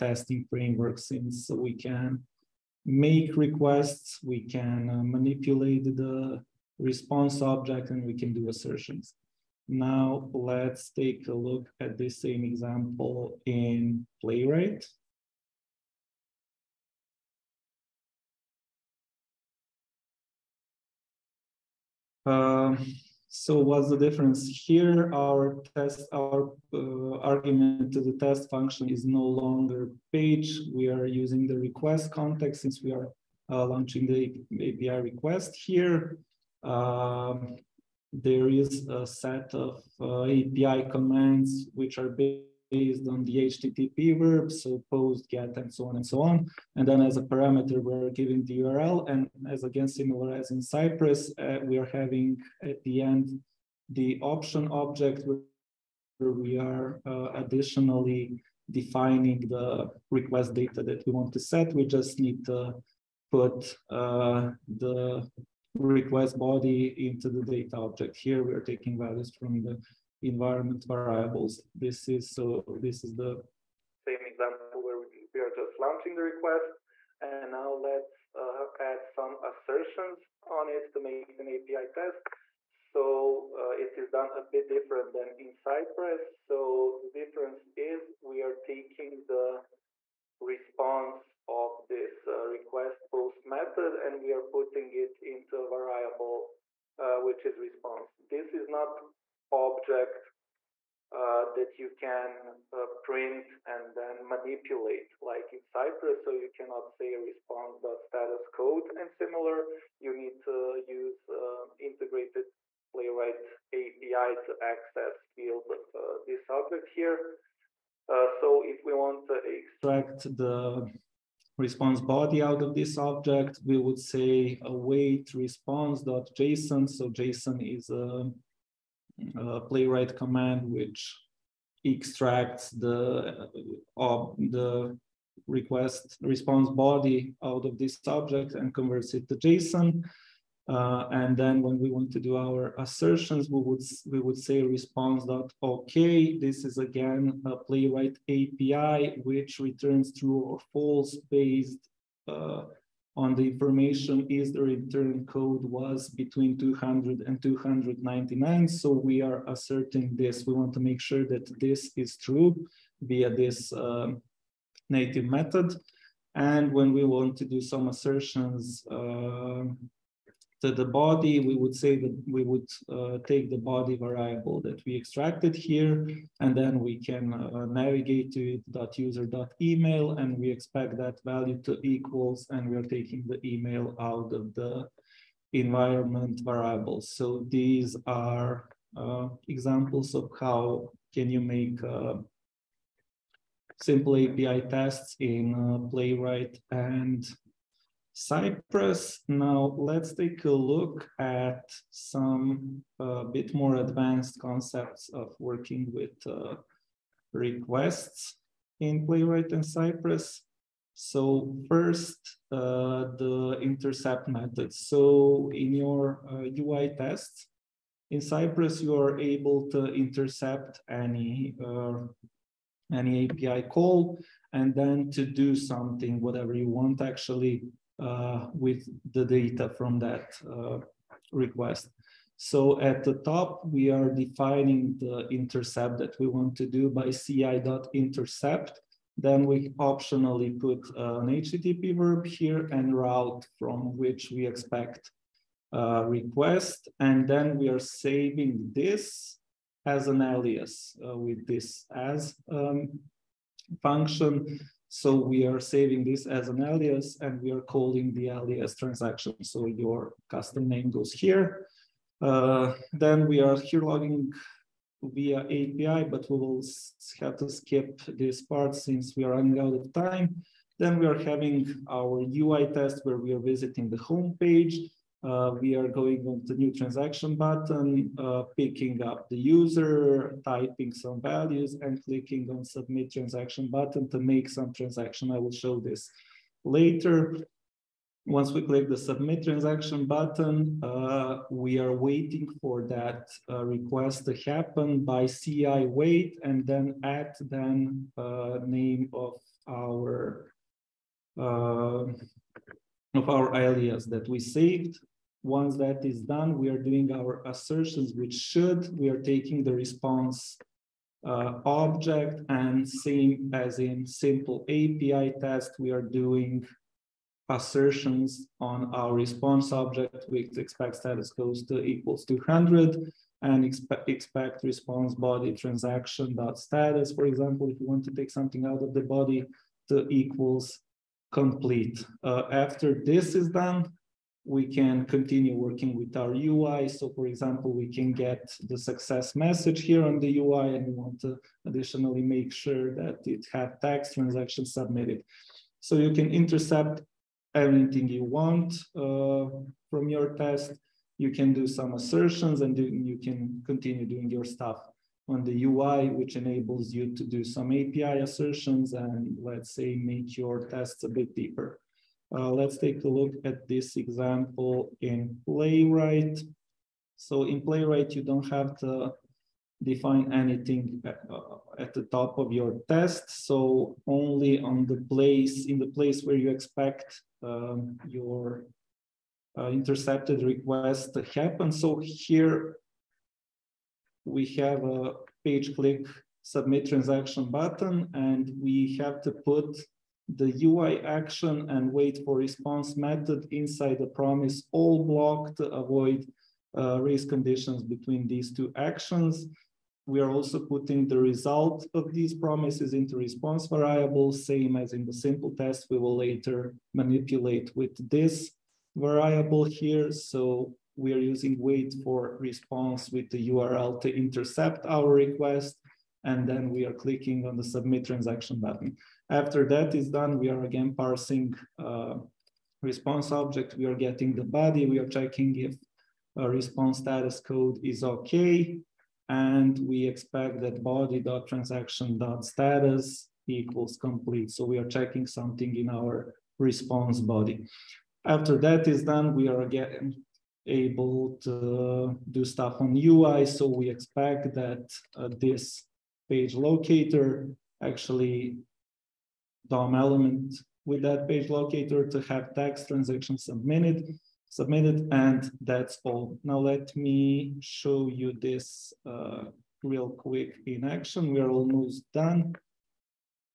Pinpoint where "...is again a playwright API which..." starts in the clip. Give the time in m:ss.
2:26.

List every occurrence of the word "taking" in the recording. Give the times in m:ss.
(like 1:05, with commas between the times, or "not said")
1:08, 1:28, 3:02, 5:09.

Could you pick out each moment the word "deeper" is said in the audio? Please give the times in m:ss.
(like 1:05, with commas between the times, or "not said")
6:01.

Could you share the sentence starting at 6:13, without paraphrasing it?
So only on the place, in the place where you expect um, your uh, intercepted request to happen.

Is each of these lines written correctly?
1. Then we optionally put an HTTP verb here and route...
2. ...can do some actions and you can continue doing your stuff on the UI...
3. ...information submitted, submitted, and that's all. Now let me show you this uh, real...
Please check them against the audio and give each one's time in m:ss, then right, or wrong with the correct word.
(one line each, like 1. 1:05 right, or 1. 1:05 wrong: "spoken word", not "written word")
1. 3:59 right
2. 5:51 wrong: "assertions", not "actions"
3. 7:32 wrong: "transaction", not "information".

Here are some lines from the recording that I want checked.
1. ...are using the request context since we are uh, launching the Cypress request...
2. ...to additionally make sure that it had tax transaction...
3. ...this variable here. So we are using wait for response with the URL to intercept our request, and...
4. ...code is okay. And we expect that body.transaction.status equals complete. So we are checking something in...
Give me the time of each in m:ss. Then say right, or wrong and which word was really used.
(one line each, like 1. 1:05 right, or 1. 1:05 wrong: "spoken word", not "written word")
1. 0:30 wrong: "API", not "Cypress"
2. 5:41 right
3. 6:48 right
4. 7:07 right.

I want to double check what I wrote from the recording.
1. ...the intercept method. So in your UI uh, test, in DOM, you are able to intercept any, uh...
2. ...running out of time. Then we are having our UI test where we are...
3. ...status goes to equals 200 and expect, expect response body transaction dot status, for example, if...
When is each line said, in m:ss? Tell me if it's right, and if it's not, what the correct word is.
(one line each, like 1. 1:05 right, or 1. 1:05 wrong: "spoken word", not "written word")
1. 3:33 wrong: "Cypress", not "DOM"
2. 4:29 right
3. 5:20 right.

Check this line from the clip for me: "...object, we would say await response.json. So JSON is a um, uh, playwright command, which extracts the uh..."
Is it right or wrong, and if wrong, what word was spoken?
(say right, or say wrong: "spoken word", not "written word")
right.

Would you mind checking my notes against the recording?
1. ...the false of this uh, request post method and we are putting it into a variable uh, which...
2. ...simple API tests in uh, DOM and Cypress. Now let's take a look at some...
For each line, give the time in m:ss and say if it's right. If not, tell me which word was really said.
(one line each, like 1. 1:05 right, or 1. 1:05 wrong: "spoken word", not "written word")
1. 1:29 wrong: "response", not "false"
2. 3:13 wrong: "Playwright", not "DOM".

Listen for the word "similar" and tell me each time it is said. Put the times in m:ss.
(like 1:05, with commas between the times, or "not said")
0:49, 1:49.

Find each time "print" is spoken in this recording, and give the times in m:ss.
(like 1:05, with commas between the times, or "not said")
1:43.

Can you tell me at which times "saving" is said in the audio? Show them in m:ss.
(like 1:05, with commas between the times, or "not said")
4:07, 4:15.